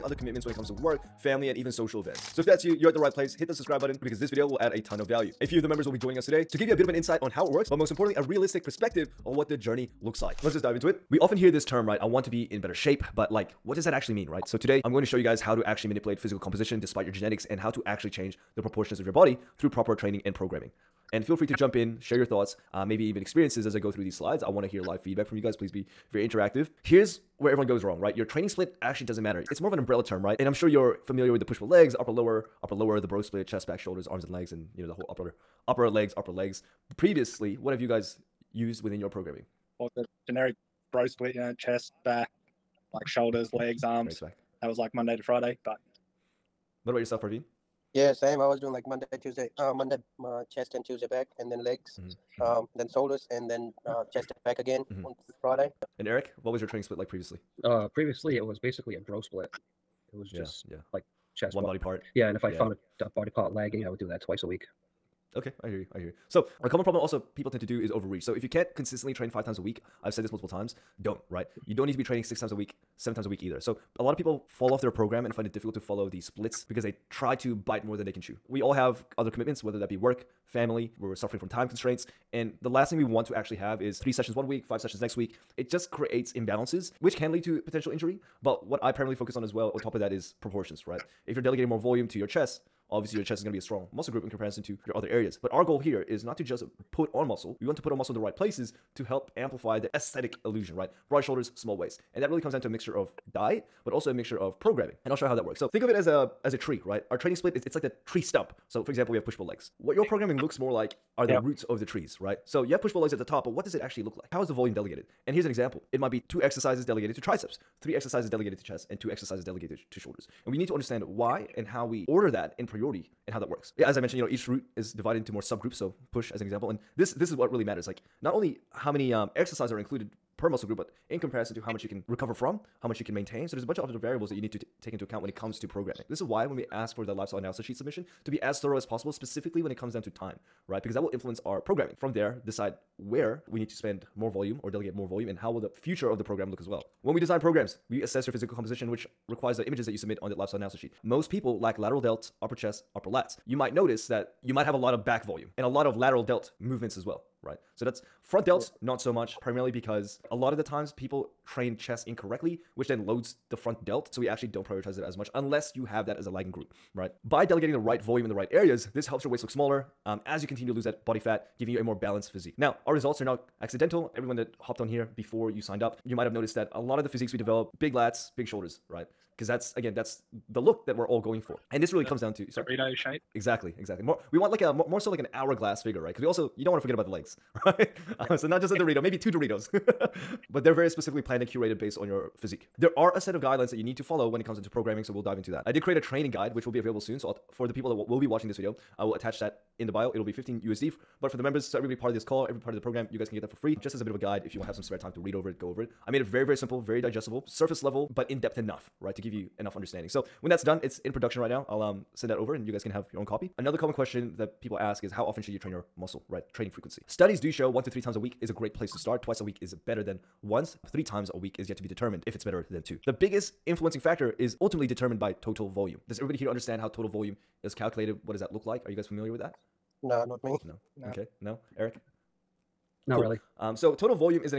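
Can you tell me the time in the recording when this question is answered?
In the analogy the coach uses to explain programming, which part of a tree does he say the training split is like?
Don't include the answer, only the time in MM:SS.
01:48.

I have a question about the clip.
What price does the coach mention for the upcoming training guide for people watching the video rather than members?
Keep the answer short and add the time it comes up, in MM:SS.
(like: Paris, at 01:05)
15 USD, at 03:20.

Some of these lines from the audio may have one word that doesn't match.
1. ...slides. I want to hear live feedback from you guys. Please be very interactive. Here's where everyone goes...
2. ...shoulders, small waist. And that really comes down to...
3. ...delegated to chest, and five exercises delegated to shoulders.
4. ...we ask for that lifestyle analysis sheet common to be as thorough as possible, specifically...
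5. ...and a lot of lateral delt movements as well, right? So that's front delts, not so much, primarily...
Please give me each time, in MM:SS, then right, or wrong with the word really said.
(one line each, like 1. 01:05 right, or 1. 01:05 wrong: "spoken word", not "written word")
1. 00:24 right
2. 01:41 right
3. 01:58 wrong: "two", not "five"
4. 02:16 wrong: "submission", not "common"
5. 02:35 right.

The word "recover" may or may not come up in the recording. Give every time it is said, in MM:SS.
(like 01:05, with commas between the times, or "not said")
02:12.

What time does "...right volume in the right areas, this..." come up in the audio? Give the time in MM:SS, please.
02:47.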